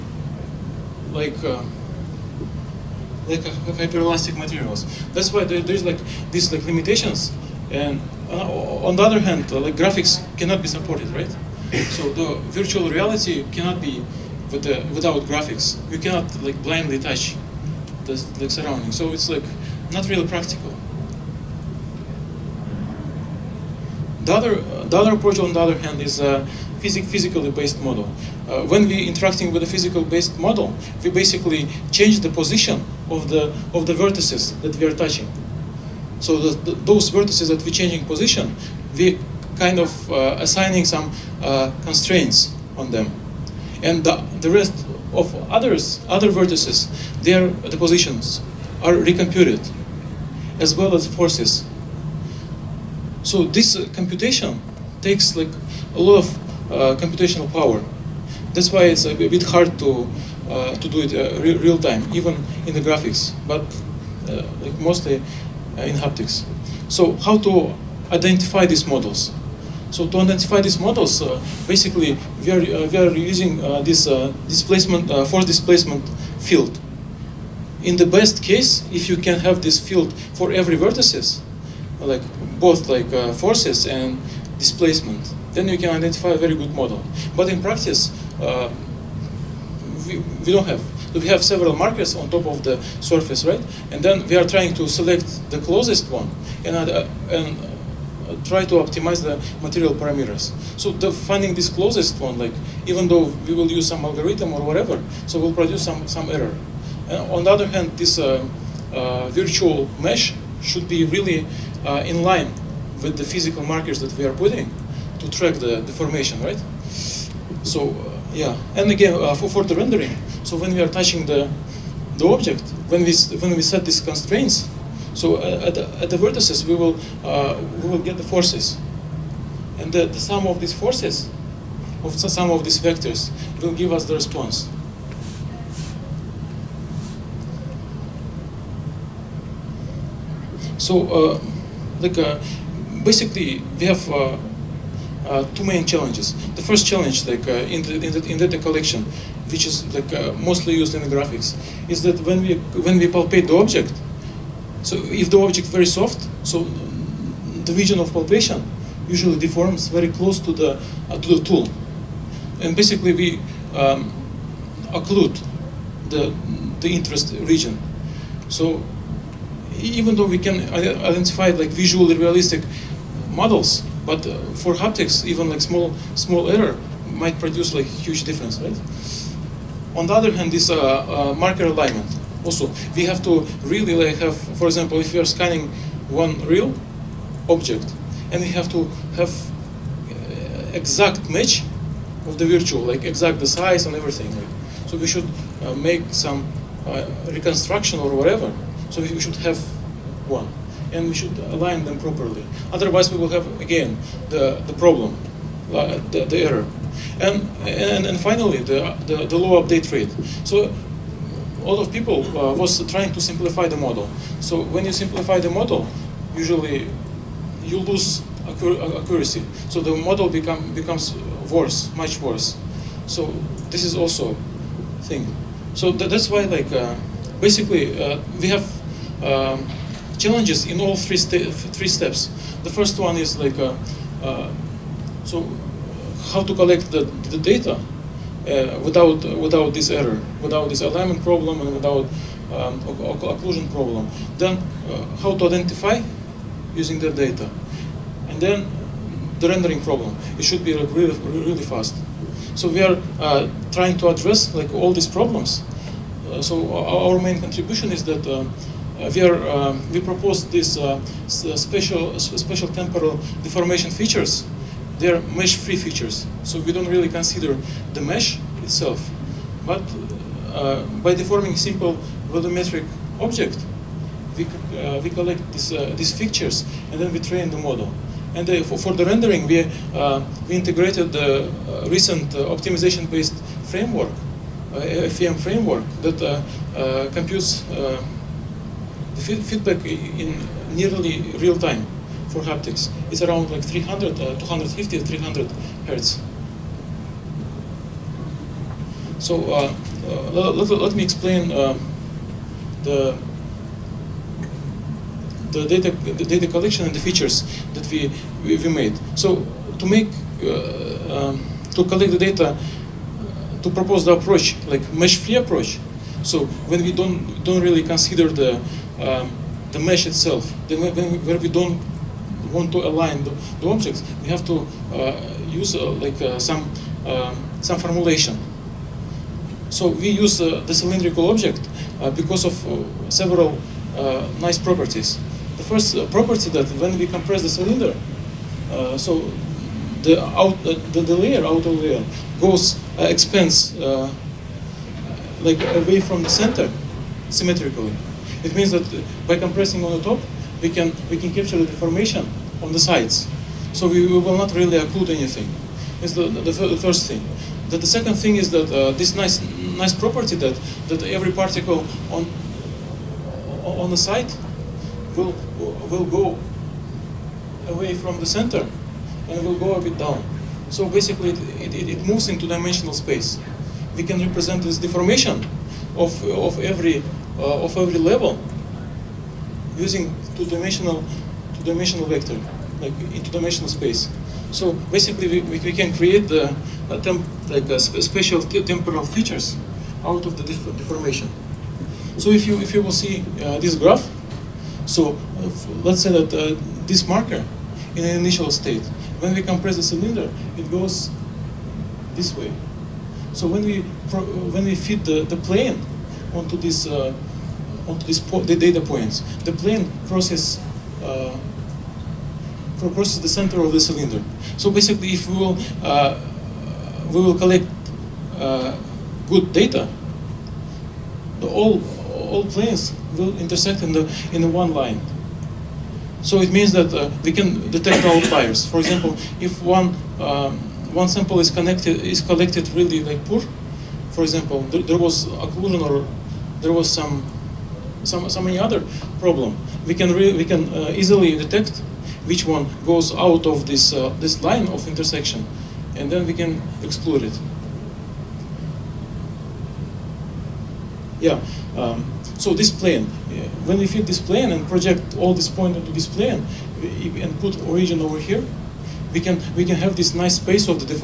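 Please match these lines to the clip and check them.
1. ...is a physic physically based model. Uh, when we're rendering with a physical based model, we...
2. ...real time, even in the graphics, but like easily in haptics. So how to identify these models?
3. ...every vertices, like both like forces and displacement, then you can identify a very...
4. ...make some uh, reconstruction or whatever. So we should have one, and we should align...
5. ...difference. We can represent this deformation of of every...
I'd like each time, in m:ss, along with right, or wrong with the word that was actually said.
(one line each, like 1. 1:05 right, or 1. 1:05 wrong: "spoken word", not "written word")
1. 0:26 wrong: "interacting", not "rendering"
2. 1:01 wrong: "mostly", not "easily"
3. 1:20 right
4. 3:15 right
5. 6:12 wrong: "space", not "difference".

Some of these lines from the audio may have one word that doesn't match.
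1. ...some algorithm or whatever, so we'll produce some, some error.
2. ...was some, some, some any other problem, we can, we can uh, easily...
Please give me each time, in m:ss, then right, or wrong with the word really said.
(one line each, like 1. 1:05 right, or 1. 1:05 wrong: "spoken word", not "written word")
1. 1:43 right
2. 7:16 right.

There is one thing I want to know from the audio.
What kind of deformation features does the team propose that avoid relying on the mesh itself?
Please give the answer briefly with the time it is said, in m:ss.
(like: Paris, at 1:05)
mesh-free features, at 4:25.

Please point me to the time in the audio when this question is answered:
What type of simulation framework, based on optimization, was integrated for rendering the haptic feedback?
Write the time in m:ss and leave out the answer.
4:45.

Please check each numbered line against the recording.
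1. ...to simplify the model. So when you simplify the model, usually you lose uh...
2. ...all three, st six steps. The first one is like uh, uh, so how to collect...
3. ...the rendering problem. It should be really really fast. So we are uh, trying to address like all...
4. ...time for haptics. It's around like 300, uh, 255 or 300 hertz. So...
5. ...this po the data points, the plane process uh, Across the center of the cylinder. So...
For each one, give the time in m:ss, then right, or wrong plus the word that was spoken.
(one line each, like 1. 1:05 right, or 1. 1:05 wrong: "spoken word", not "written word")
1. 3:33 right
2. 3:50 wrong: "three", not "six"
3. 4:09 right
4. 4:51 wrong: "250", not "255"
5. 6:48 right.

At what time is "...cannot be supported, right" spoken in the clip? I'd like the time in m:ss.
0:10.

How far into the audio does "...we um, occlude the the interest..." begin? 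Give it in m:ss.
2:43.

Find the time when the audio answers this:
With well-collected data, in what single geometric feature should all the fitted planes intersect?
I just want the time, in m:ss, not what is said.
7:04.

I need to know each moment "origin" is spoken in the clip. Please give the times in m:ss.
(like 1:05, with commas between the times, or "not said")
7:37.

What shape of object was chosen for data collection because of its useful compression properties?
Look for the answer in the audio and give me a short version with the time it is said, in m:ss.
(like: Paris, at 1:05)
cylindrical, at 5:30.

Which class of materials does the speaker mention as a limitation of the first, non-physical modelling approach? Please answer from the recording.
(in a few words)
hyperelastic materials.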